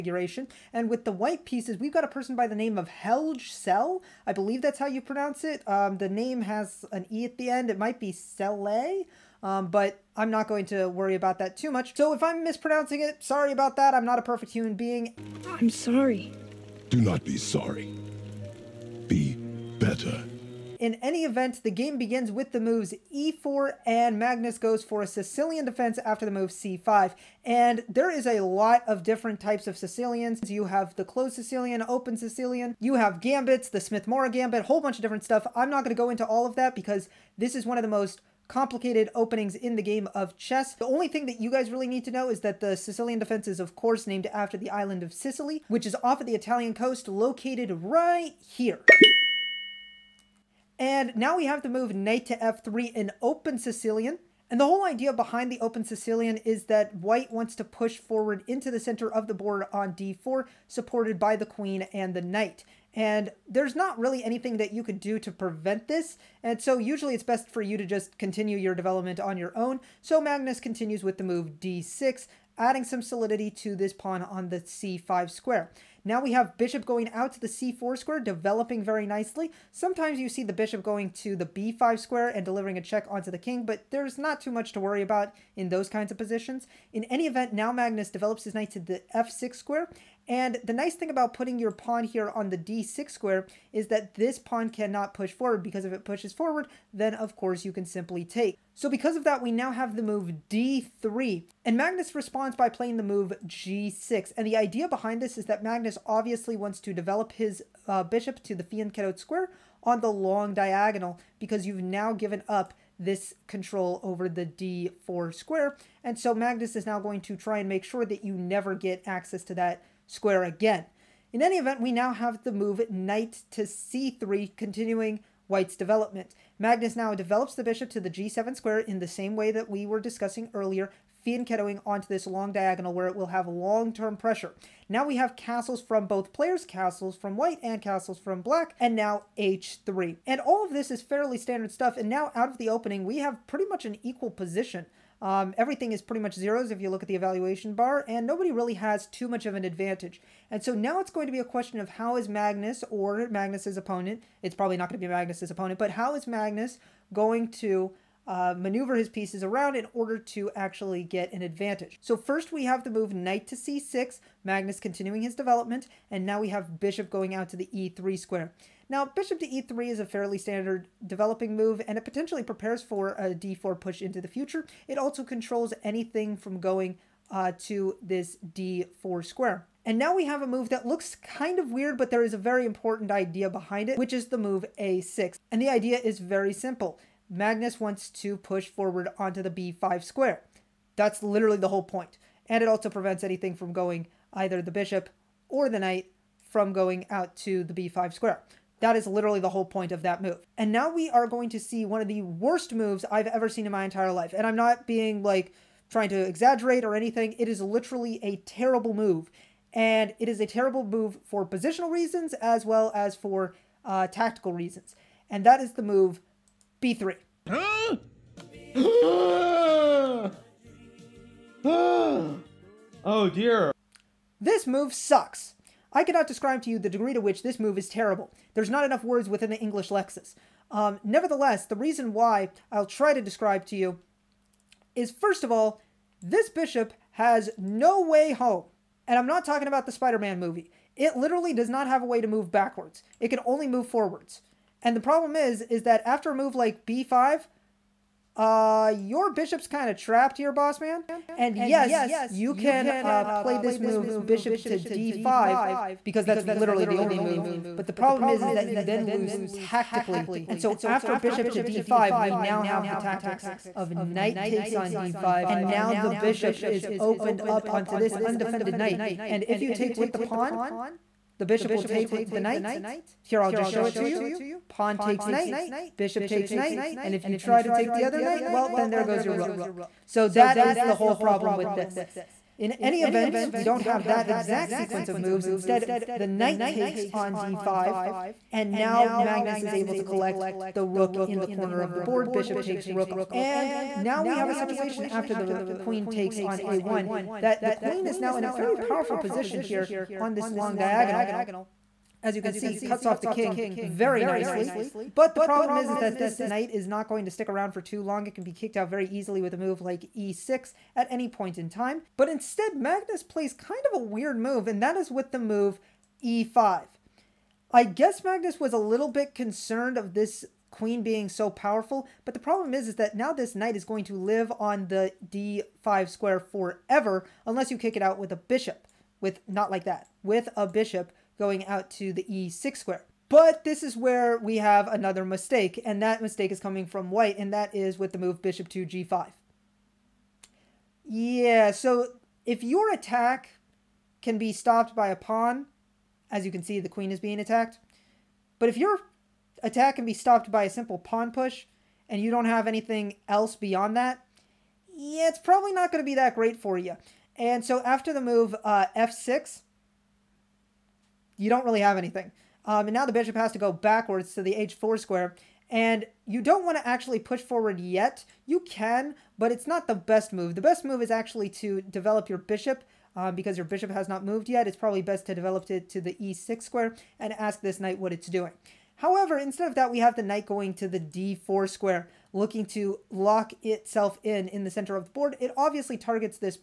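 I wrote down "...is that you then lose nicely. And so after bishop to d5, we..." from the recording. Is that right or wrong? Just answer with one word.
wrong.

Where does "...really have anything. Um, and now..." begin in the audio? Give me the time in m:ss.
6:01.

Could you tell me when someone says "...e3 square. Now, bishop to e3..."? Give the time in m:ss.
2:47.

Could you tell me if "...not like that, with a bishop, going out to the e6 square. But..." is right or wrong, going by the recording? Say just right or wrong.
right.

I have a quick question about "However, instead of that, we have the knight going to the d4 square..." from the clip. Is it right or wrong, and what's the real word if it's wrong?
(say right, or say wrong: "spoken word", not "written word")
right.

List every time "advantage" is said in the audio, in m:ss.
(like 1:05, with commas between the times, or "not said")
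2:29, 2:41.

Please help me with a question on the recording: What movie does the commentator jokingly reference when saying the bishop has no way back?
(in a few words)
Spider Man.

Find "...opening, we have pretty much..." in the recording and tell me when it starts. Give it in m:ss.
2:22.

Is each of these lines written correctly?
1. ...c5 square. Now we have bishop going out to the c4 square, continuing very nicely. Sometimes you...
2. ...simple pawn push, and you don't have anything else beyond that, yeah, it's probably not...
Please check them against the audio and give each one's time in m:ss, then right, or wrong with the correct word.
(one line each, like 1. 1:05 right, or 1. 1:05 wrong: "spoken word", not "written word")
1. 1:14 wrong: "developing", not "continuing"
2. 5:50 right.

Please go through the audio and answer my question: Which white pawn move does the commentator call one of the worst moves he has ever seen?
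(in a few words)
b3.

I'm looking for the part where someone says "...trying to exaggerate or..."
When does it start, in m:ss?
3:25.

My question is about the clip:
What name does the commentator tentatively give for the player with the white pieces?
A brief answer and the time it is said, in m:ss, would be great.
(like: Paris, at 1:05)
Helge Sel, at 0:02.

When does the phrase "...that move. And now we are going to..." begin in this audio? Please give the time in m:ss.
3:20.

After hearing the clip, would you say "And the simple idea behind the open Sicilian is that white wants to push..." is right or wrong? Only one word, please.
wrong.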